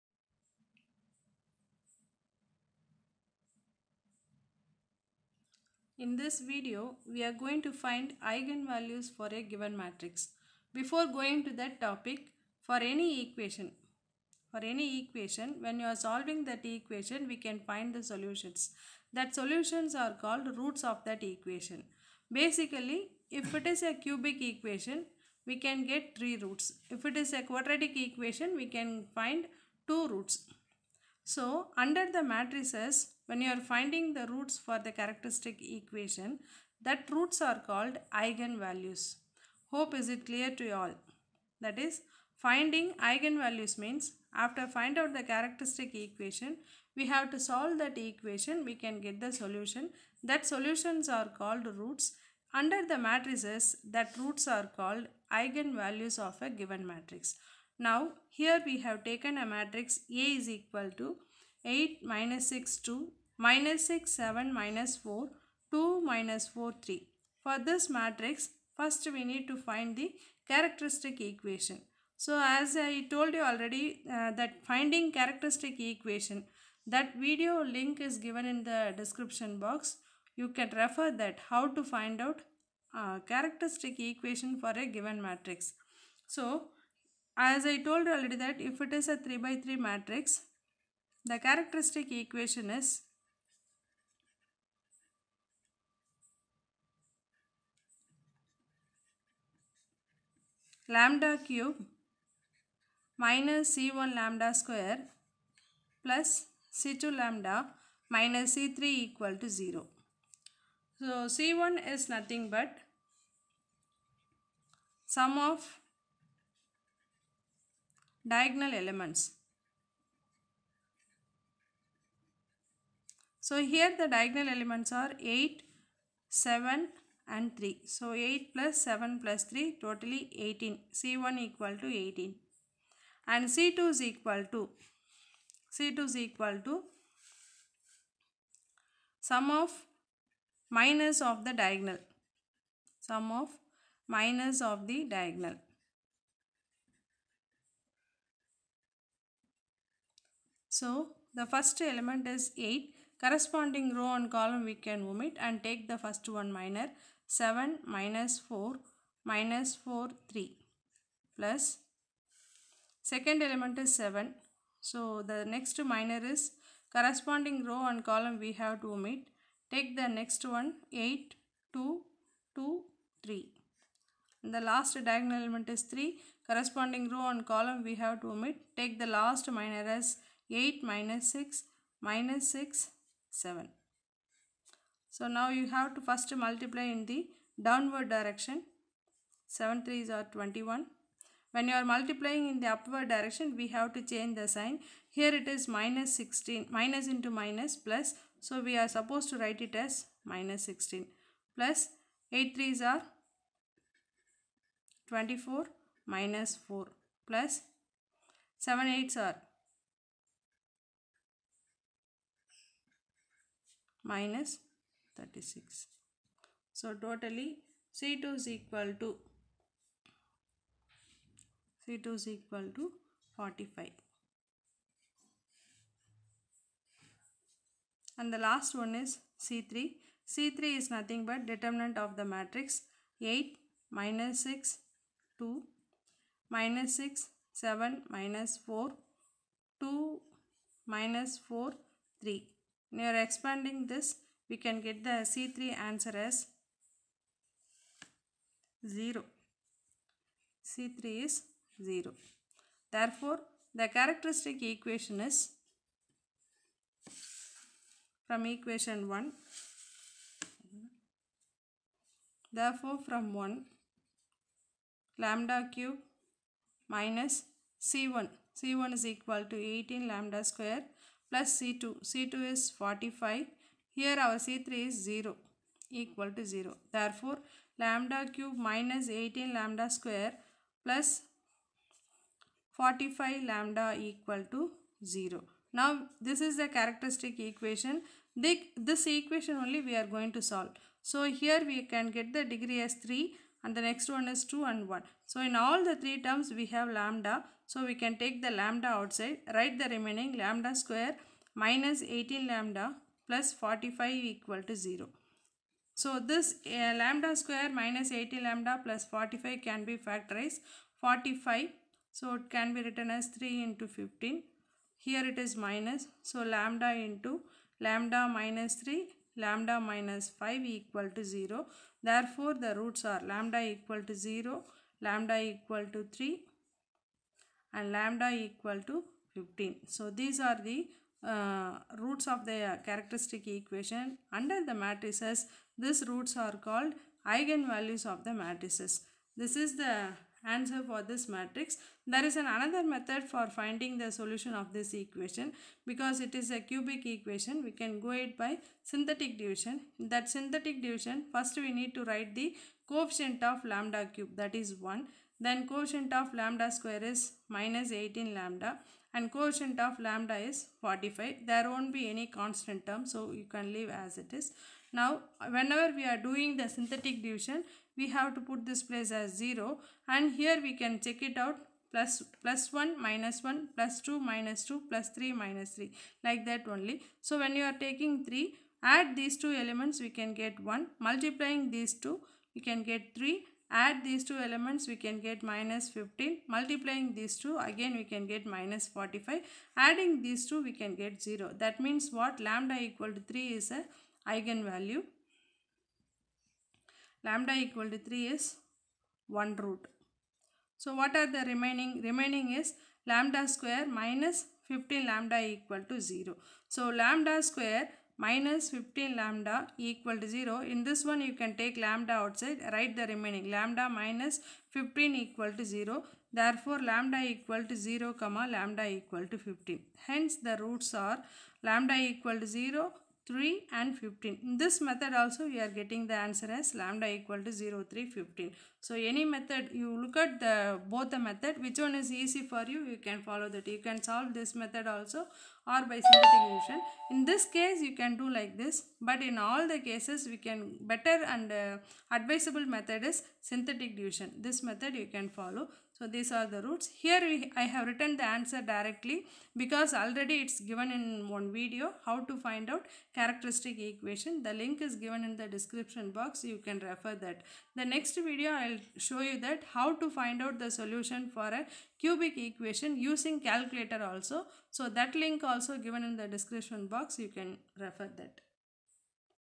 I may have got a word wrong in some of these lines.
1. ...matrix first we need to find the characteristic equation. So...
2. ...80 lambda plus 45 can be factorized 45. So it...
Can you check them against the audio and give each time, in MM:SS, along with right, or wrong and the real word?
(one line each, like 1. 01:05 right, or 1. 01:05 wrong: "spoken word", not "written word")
1. 01:07 right
2. 05:08 right.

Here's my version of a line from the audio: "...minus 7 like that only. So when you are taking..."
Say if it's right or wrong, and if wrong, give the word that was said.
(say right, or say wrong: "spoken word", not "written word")
wrong: "3", not "7".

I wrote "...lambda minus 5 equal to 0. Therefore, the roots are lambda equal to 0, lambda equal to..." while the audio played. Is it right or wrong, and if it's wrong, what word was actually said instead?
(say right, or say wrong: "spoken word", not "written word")
right.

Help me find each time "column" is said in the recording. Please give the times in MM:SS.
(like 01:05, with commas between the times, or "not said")
02:34, 02:48, 02:57.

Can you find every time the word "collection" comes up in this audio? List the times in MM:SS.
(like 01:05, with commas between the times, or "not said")
not said.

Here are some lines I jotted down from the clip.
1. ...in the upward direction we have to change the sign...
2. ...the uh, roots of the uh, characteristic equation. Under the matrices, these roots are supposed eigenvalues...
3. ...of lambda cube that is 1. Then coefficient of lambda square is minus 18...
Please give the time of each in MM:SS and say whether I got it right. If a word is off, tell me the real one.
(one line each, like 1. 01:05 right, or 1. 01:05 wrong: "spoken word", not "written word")
1. 03:12 right
2. 05:30 wrong: "called", not "supposed"
3. 05:53 right.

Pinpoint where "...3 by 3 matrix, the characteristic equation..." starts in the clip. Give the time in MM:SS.
01:29.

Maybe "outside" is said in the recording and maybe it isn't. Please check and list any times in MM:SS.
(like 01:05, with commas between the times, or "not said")
04:58, 06:52.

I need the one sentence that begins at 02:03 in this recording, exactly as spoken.
So here the diagonal elements are 8, 7 and 3.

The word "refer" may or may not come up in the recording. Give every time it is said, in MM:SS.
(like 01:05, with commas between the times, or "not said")
01:20, 07:36, 07:47.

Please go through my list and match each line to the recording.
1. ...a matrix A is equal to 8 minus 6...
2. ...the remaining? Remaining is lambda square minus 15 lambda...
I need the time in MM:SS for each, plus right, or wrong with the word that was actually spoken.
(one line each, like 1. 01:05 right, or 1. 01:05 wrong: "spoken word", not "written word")
1. 00:59 right
2. 06:41 right.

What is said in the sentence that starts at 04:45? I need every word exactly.
Now, this is the characteristic equation.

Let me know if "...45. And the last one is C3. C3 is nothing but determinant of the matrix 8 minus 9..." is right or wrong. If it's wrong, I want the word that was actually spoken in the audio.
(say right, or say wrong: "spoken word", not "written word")
wrong: "6", not "9".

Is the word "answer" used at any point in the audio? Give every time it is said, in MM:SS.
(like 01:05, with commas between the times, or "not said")
04:05, 05:40, 07:06, 07:28.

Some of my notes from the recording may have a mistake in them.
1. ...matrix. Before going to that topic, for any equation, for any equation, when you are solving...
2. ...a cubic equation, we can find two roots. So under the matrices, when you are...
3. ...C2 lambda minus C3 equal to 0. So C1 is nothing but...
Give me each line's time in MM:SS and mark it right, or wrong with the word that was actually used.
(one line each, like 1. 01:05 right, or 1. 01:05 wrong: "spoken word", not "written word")
1. 00:09 right
2. 00:27 wrong: "quadratic", not "cubic"
3. 01:46 right.